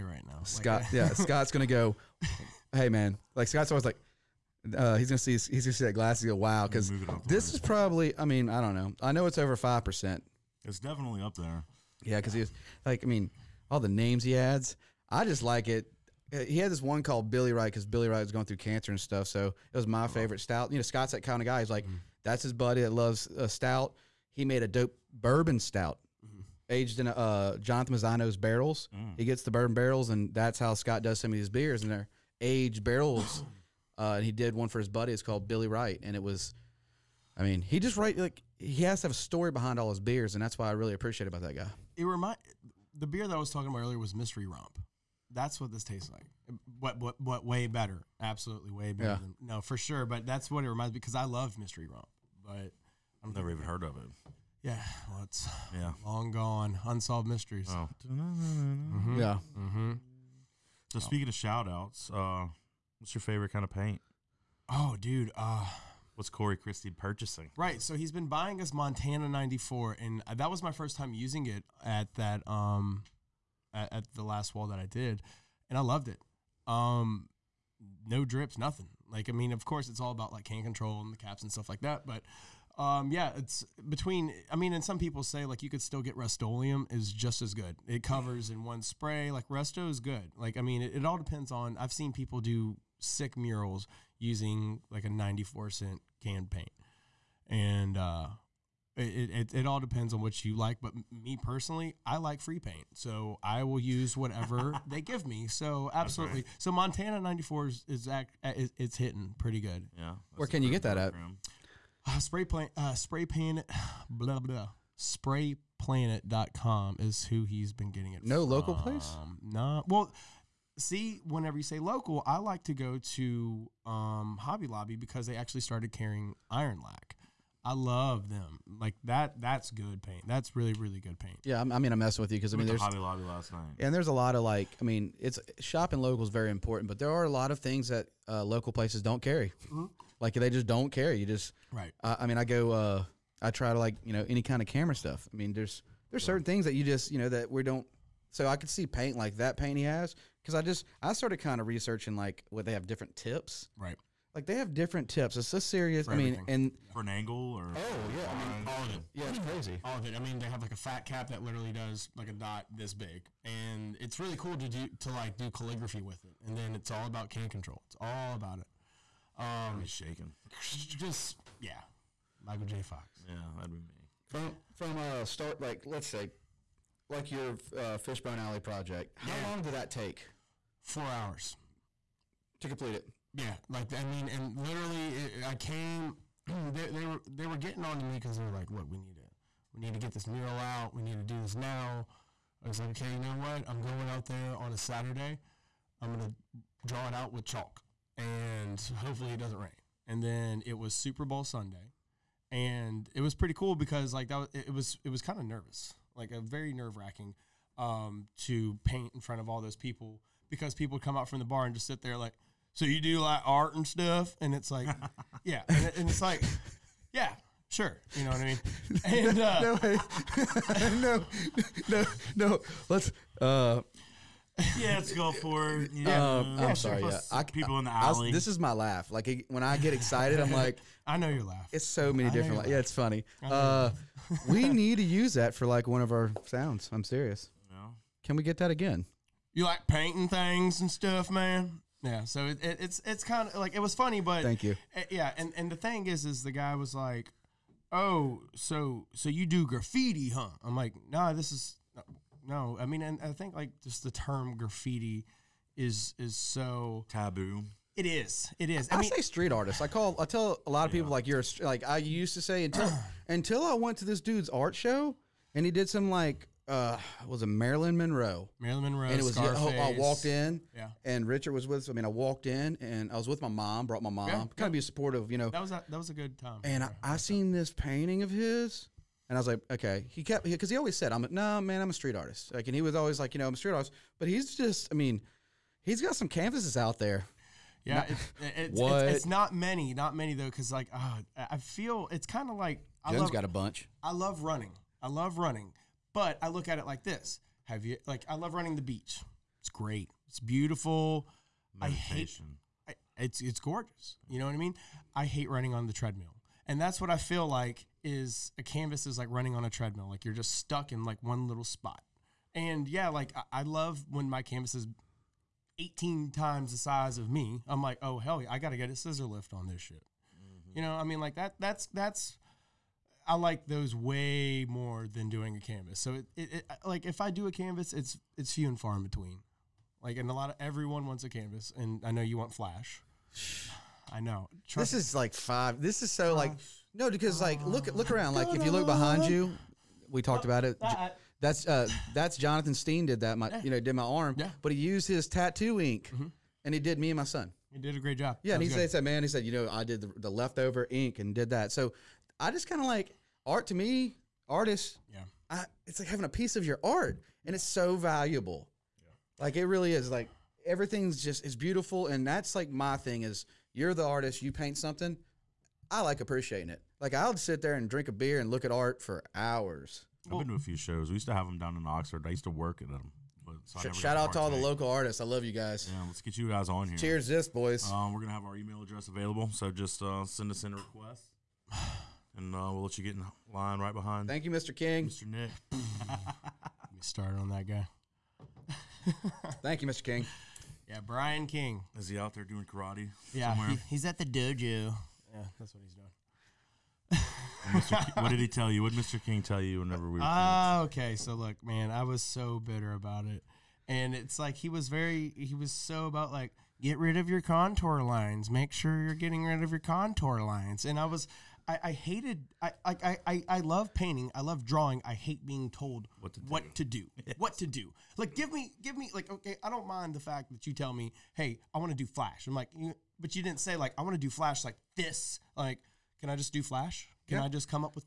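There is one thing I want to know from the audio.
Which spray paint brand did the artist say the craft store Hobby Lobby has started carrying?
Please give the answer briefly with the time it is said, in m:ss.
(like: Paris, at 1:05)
Ironlak, at 2:06.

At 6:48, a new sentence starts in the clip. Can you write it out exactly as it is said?
Make sure you're getting rid of your contour lines.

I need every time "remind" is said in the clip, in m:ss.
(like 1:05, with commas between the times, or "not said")
0:42, 0:50.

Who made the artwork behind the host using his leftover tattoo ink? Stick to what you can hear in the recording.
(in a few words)
Jonathan Steen.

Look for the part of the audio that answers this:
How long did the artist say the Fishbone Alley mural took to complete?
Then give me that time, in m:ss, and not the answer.
3:00.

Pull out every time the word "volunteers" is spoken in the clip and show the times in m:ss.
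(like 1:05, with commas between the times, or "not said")
not said.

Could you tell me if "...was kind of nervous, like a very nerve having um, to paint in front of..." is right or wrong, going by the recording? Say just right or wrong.
wrong.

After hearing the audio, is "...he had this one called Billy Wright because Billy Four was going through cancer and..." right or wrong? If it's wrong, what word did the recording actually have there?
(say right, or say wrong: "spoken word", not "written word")
wrong: "Wright", not "Four".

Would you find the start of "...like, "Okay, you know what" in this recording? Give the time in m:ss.
3:12.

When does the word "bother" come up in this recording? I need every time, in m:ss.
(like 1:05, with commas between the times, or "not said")
not said.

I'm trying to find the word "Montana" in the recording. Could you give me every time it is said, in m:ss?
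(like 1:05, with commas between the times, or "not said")
1:08, 1:46.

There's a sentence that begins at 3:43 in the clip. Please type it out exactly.
Uh, yeah, let's go for it.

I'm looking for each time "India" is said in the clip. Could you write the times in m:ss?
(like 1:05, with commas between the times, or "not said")
not said.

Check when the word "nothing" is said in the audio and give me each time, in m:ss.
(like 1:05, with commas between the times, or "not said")
1:18.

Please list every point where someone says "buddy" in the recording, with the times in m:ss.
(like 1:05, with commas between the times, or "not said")
0:22, 0:34.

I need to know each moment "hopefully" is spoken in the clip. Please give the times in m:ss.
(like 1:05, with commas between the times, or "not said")
3:18.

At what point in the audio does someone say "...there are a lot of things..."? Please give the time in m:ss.
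2:16.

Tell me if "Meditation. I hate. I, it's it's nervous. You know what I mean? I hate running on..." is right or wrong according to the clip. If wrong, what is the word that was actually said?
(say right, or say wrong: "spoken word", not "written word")
wrong: "gorgeous", not "nervous".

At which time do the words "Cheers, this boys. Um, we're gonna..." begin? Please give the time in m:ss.
6:16.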